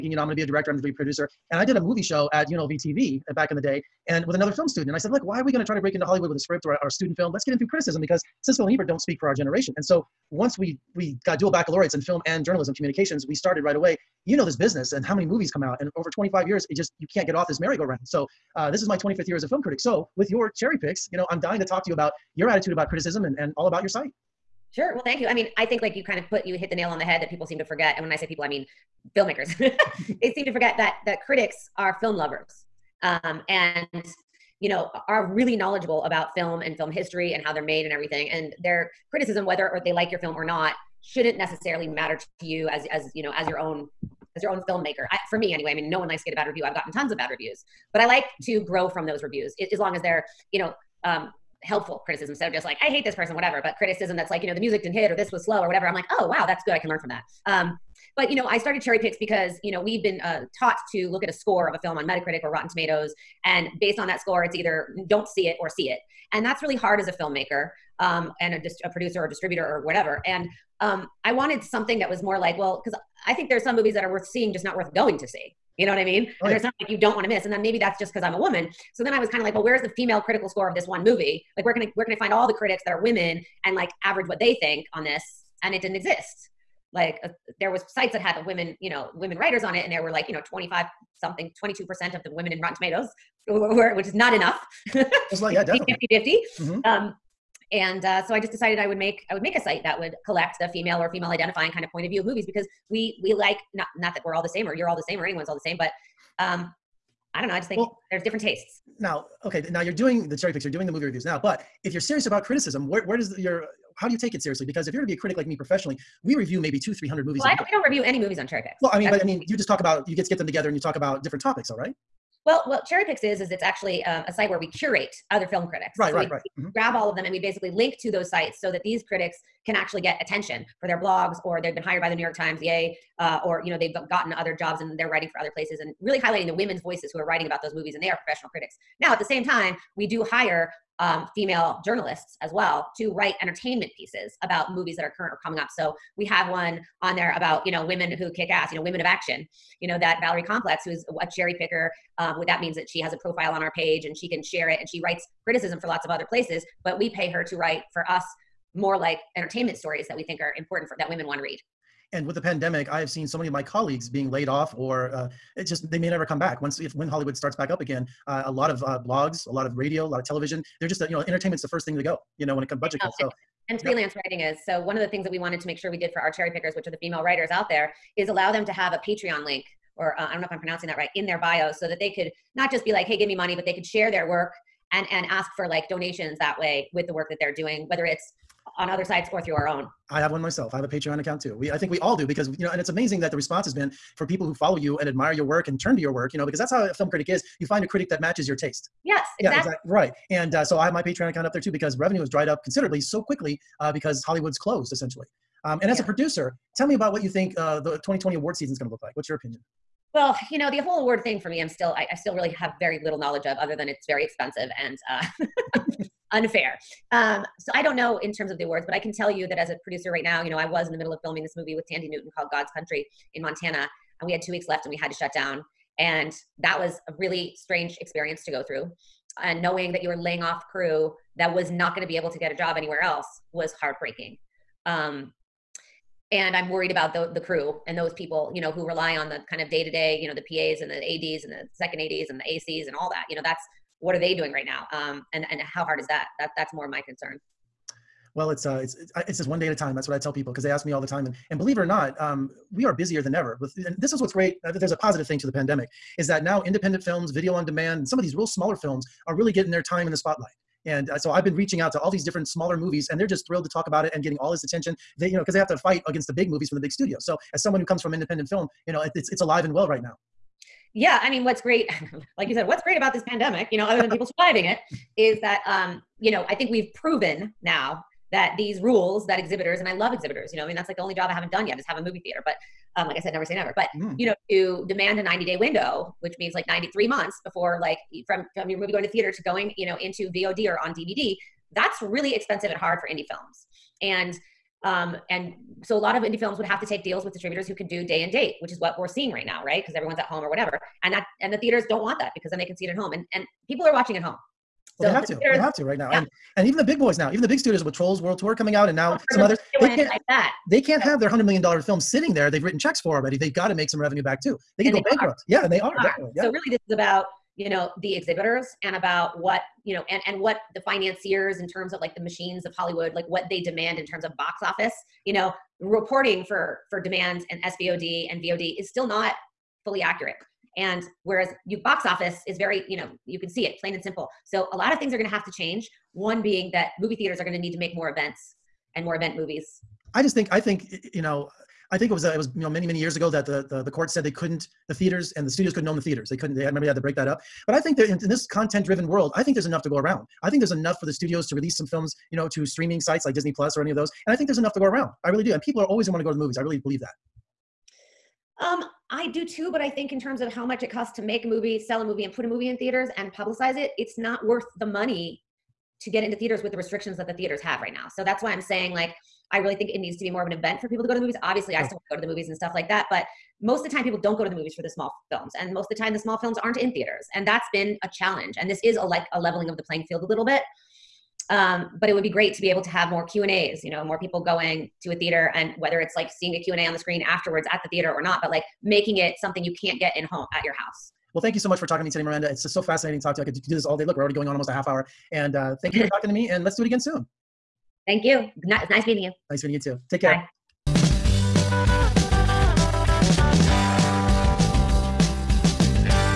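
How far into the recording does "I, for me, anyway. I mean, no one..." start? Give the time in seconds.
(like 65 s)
45 s.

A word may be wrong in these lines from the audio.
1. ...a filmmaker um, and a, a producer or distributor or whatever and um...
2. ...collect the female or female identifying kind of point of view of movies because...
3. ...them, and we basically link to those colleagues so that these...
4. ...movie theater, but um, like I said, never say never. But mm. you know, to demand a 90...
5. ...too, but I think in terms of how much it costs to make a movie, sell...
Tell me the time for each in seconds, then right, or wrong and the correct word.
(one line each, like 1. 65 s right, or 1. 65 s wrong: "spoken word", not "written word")
1. 67 s right
2. 100 s right
3. 127 s wrong: "sites", not "colleagues"
4. 282 s right
5. 359 s right.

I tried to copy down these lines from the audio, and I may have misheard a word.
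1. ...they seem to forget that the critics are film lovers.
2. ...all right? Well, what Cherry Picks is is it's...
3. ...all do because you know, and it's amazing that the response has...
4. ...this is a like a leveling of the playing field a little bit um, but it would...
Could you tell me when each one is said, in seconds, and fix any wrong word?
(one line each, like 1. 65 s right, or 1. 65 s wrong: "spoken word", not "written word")
1. 30 s right
2. 121 s right
3. 191 s right
4. 378 s right.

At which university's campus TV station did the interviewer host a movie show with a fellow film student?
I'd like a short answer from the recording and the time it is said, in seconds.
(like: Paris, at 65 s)
UNLV, at 2 s.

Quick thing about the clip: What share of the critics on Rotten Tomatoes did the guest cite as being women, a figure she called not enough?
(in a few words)
22%.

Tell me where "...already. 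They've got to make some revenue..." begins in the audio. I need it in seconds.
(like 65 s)
313 s.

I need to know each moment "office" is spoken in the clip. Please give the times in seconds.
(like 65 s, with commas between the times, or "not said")
324 s, 332 s.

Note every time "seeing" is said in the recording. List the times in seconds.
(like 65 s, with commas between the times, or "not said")
74 s, 299 s, 386 s.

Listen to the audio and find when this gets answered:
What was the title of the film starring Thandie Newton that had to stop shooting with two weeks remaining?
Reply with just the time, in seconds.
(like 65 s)
222 s.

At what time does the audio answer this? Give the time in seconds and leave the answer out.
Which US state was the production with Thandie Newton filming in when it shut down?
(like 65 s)
223 s.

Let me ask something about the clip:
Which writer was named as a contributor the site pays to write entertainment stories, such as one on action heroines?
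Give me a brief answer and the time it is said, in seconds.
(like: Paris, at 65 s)
Valerie Complex, at 150 s.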